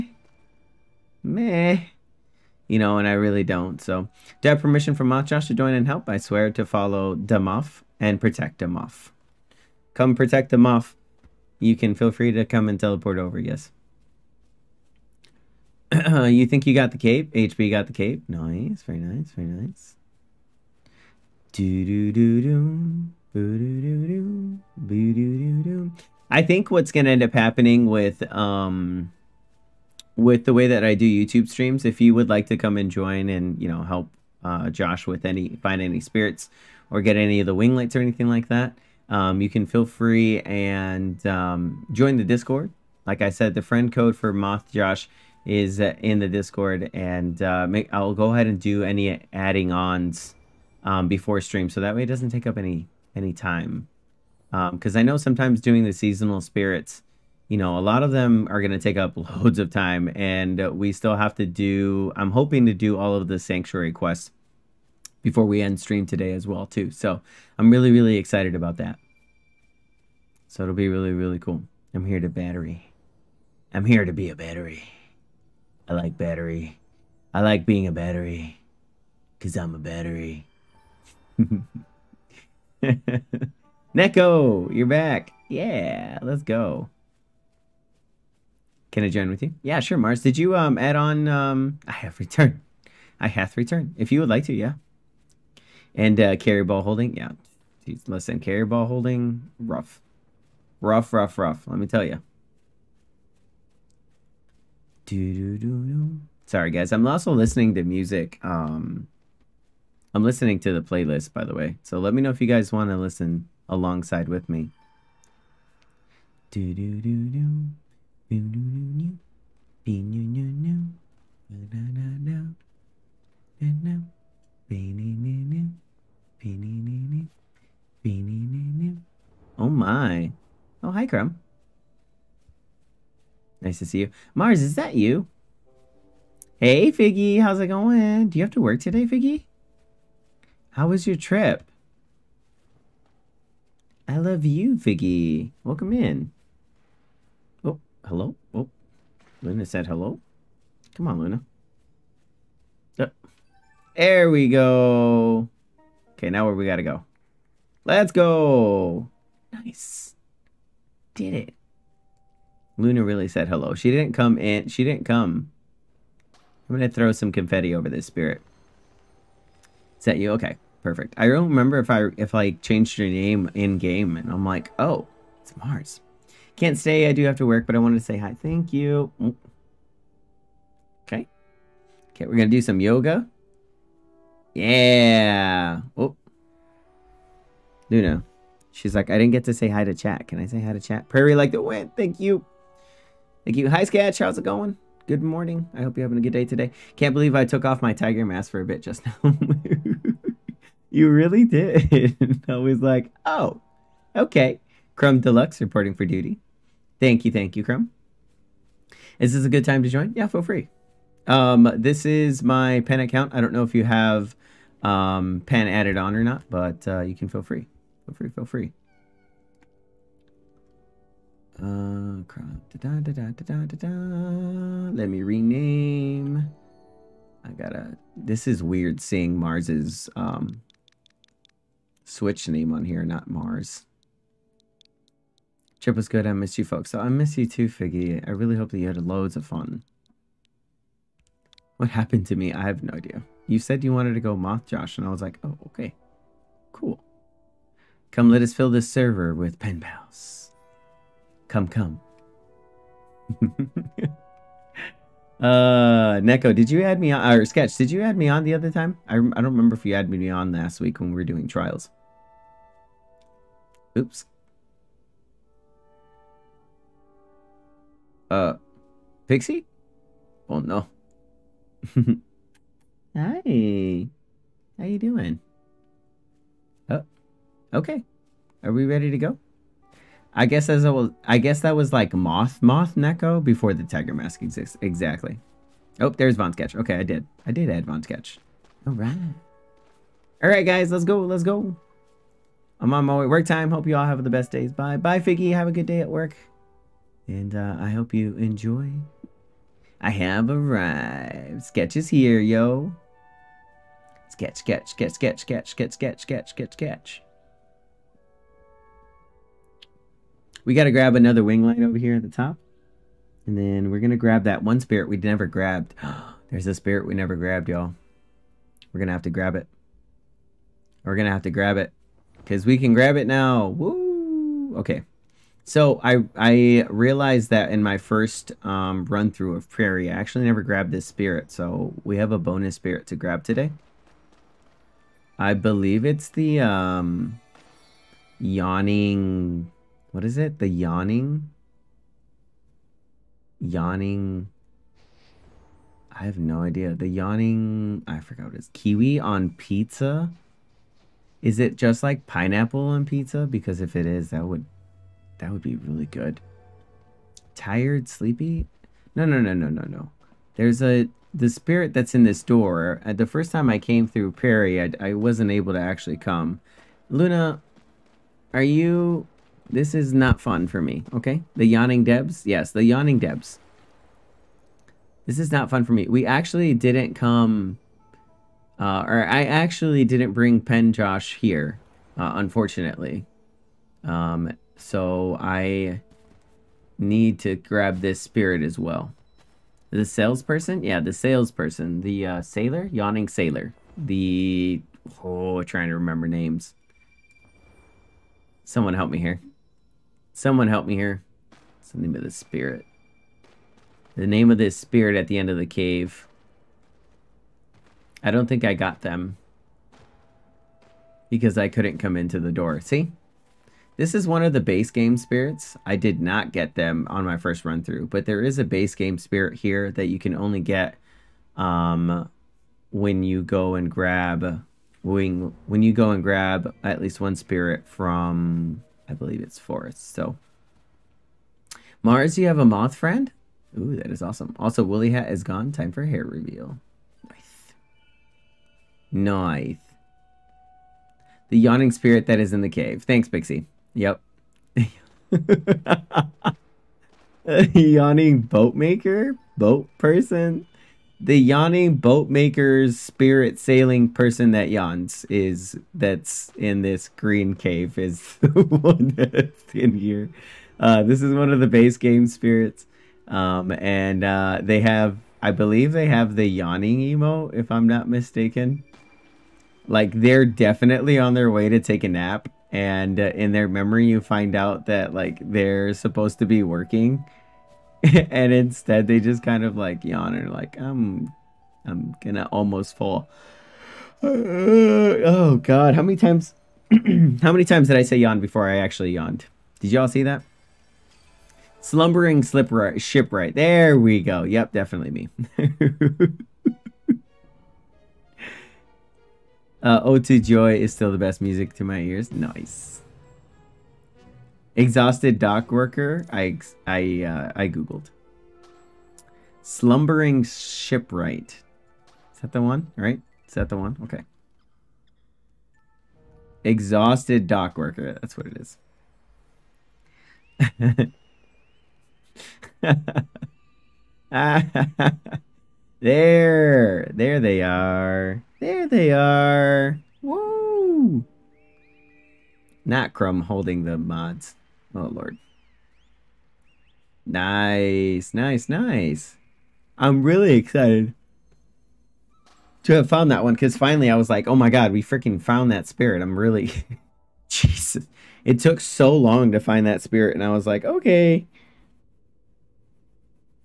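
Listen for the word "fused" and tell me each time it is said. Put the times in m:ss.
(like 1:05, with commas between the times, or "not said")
not said.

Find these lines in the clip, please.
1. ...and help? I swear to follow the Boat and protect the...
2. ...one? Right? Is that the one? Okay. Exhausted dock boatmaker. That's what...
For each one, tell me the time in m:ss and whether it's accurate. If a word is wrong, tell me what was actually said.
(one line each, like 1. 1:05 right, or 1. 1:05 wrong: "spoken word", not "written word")
1. 0:05 wrong: "Muff", not "Boat"
2. 8:32 wrong: "worker", not "boatmaker".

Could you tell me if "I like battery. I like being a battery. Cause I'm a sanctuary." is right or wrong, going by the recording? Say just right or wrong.
wrong.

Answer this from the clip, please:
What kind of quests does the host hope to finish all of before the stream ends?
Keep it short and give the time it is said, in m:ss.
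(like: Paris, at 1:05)
sanctuary quests, at 1:03.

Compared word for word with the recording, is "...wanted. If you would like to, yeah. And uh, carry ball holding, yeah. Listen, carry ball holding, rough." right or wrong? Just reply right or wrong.
wrong.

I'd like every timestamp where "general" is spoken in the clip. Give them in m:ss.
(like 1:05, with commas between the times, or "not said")
not said.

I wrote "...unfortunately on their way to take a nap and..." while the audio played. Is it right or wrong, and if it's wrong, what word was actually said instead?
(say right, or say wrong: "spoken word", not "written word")
wrong: "definitely", not "unfortunately".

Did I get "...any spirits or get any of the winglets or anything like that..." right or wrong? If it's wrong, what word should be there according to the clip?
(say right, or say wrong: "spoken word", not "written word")
right.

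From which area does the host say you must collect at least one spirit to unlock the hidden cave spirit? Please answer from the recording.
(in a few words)
forest.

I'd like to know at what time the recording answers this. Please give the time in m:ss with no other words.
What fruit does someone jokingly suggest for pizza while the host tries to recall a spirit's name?
5:48.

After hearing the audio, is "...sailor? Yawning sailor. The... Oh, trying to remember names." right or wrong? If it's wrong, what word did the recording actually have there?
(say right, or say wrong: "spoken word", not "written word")
right.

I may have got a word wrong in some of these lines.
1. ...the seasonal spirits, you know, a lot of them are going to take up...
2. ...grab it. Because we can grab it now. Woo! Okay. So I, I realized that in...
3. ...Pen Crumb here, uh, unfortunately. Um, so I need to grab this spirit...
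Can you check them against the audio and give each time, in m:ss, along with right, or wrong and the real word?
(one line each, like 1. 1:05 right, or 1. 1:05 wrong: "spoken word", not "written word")
1. 0:55 right
2. 5:21 right
3. 6:20 wrong: "Josh", not "Crumb".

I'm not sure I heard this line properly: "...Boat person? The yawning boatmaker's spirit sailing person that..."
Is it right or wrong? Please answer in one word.
right.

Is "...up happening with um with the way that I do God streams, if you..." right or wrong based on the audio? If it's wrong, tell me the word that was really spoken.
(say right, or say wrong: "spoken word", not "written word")
wrong: "YouTube", not "God".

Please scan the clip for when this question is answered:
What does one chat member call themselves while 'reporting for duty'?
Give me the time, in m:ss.
3:24.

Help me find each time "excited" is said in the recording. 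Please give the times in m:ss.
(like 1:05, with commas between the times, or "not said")
1:08, 9:00.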